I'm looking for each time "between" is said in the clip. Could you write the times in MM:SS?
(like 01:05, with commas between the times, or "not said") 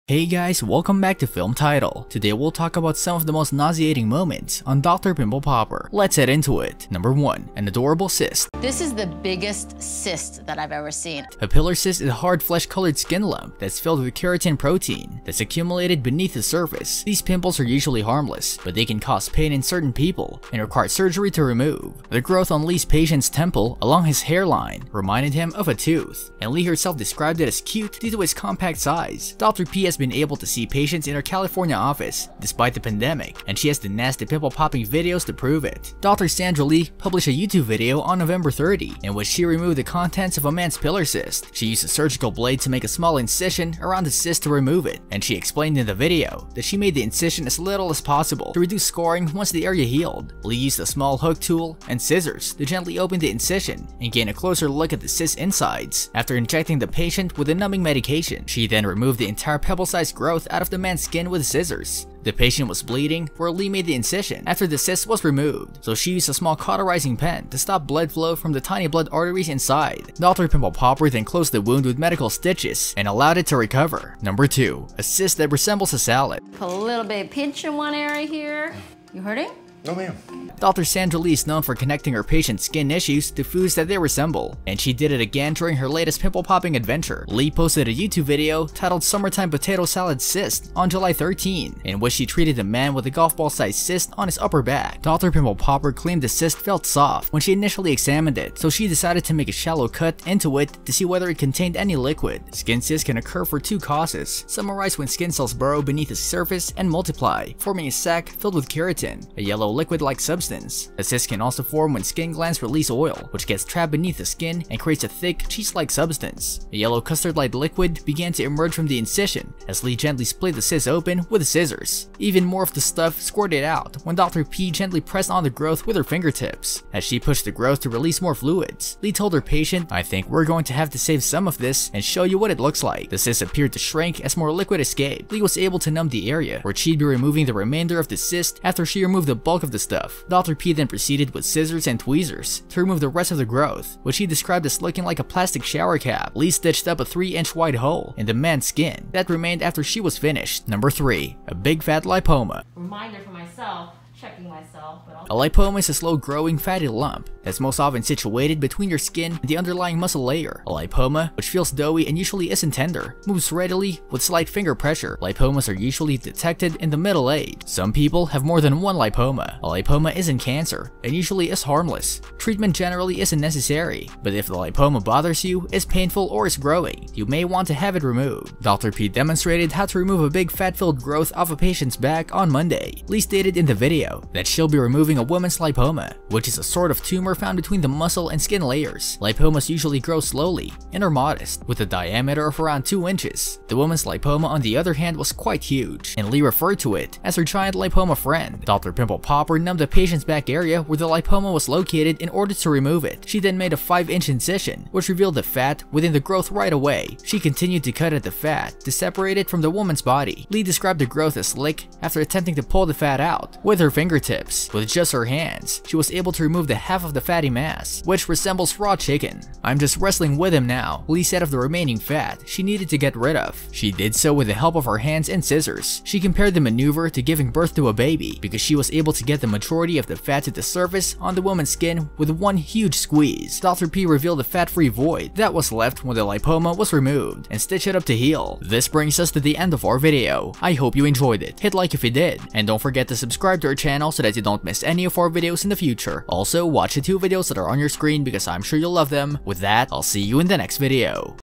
02:38, 03:07.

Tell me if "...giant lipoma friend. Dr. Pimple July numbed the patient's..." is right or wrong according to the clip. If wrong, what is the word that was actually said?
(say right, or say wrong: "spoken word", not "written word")
wrong: "Popper", not "July".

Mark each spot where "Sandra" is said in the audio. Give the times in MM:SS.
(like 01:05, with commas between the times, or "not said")
00:36, 01:20.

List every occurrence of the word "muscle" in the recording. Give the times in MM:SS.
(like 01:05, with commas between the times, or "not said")
02:39, 03:07.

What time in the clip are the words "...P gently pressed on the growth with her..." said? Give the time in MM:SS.
02:04.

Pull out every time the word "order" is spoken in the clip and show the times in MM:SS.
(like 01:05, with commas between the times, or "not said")
03:22.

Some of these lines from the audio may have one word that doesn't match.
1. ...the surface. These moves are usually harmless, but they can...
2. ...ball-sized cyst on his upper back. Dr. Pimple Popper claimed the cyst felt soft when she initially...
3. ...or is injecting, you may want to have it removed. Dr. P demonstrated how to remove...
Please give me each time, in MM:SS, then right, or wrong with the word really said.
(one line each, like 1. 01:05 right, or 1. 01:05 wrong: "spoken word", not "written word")
1. 00:16 wrong: "pimples", not "moves"
2. 01:33 right
3. 02:56 wrong: "growing", not "injecting".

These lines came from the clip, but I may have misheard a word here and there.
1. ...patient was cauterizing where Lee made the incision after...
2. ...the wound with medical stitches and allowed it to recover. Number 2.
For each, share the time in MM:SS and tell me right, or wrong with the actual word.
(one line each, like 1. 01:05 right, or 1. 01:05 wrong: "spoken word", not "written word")
1. 01:02 wrong: "bleeding", not "cauterizing"
2. 01:11 right.